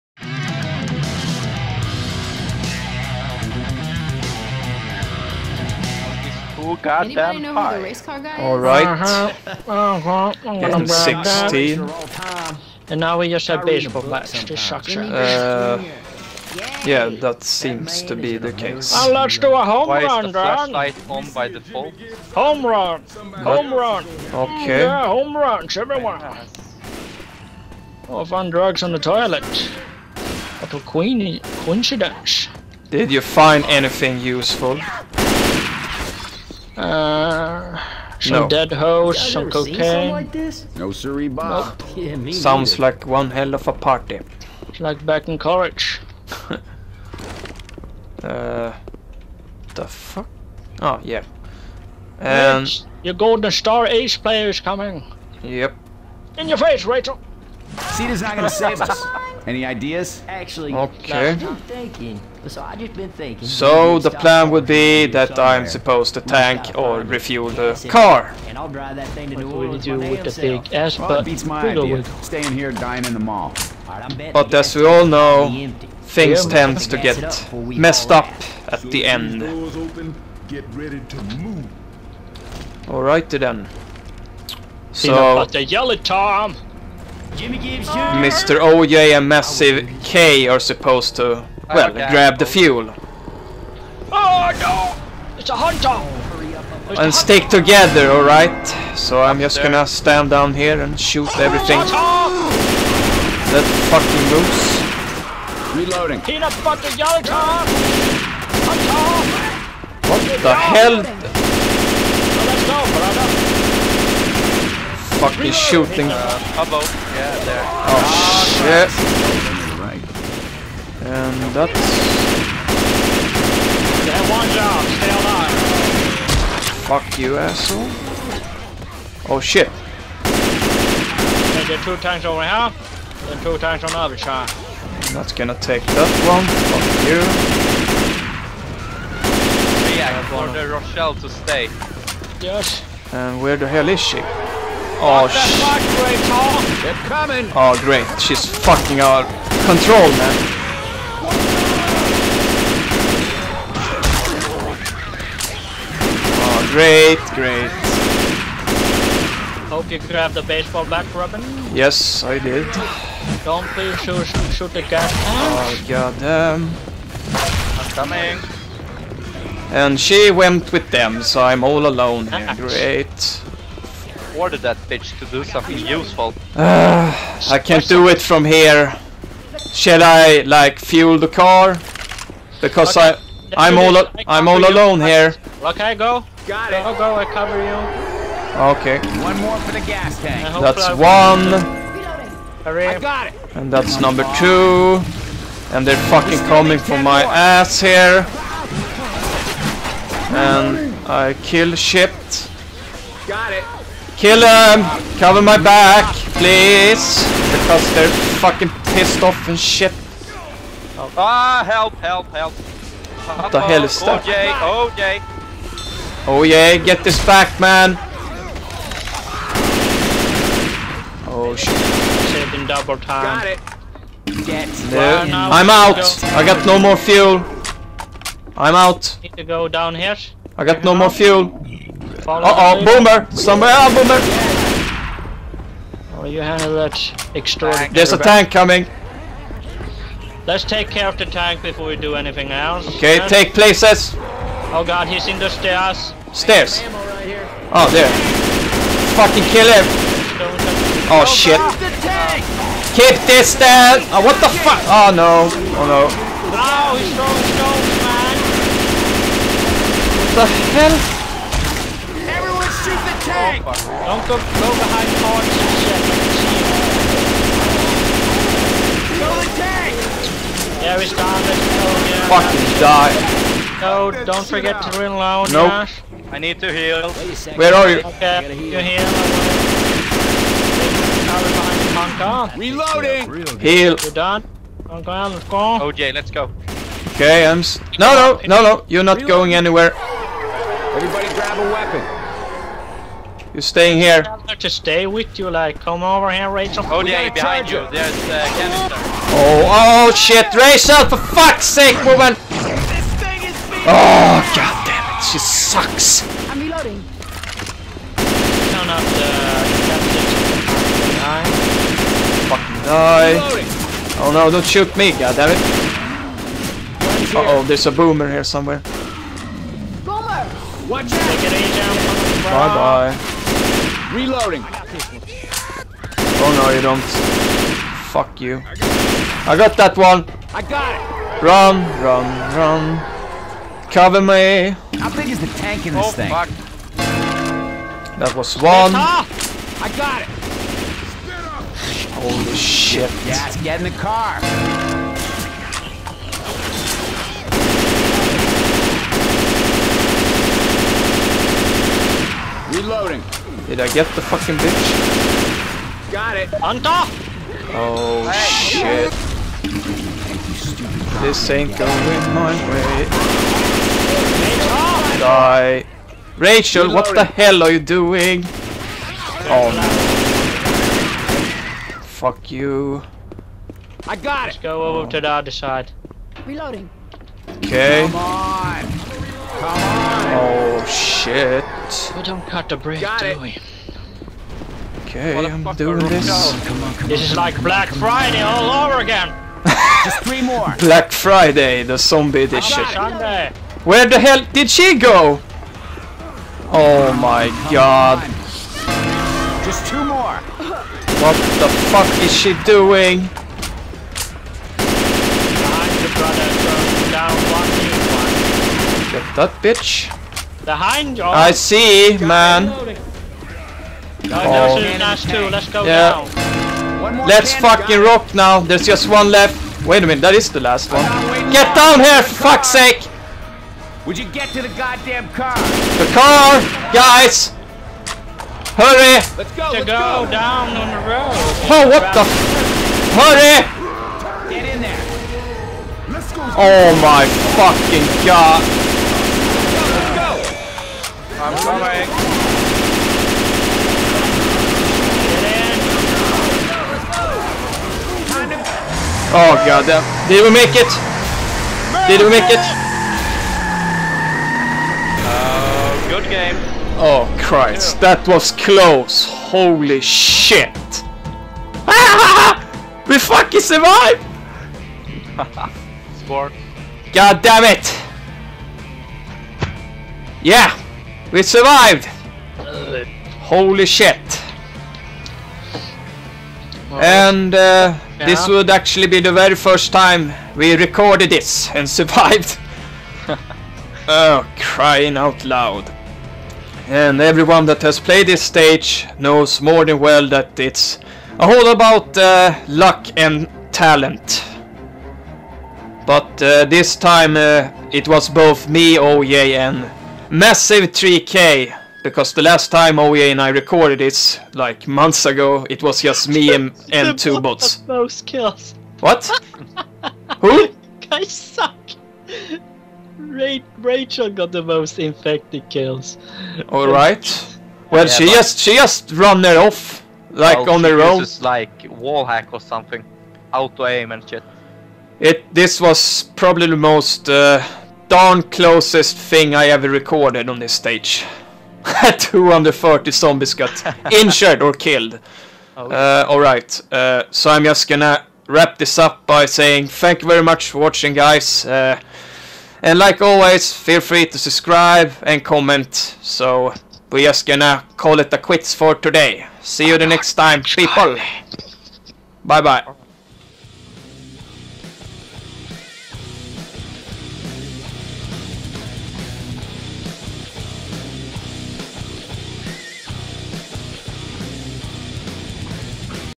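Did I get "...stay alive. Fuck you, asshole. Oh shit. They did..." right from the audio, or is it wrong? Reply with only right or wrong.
right.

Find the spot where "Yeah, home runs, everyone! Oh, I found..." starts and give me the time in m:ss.
0:24.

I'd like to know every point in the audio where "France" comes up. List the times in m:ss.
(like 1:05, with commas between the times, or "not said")
not said.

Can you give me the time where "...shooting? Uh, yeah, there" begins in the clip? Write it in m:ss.
1:55.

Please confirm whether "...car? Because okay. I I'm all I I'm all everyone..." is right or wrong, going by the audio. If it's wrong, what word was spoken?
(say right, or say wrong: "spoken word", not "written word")
wrong: "alone", not "everyone".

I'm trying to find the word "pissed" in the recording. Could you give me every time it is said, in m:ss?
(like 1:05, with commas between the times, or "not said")
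3:28.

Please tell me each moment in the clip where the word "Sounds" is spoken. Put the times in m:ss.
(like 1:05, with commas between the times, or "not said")
0:42.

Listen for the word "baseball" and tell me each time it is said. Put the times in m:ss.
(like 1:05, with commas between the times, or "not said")
0:13, 2:40.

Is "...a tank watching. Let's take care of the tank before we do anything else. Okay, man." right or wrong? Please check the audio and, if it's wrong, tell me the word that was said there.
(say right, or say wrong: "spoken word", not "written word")
wrong: "coming", not "watching".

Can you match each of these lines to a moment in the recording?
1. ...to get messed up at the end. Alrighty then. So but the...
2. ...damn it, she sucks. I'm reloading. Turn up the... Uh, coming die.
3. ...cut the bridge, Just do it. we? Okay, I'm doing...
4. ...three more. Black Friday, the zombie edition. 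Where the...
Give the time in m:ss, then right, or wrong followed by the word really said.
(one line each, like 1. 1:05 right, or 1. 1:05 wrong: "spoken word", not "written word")
1. 1:16 right
2. 5:04 wrong: "fucking", not "coming"
3. 6:22 wrong: "Got", not "Just"
4. 6:30 right.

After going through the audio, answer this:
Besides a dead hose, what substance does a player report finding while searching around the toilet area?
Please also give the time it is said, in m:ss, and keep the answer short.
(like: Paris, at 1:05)
Cocaine, at 0:39.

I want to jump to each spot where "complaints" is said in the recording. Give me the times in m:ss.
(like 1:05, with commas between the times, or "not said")
not said.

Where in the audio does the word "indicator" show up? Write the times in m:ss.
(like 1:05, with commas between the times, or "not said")
not said.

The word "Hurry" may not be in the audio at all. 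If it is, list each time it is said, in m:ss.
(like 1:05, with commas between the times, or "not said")
3:12, 7:08, 7:13.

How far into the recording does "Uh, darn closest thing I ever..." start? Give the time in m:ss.
8:47.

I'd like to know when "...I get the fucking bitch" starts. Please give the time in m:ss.
5:53.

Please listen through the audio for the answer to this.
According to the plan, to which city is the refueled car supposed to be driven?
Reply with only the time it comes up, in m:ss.
1:09.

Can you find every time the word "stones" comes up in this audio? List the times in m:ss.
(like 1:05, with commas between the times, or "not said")
4:20.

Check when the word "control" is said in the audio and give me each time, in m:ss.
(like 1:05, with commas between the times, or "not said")
2:29.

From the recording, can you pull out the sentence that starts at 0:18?
And let's do a home Why run, is the flashlight Dan.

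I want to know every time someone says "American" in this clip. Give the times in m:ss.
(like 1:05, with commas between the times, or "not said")
not said.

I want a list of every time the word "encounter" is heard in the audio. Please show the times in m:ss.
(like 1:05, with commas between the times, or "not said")
not said.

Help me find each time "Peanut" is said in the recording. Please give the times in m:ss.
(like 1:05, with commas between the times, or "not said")
1:46.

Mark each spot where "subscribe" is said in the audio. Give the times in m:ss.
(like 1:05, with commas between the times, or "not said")
9:04.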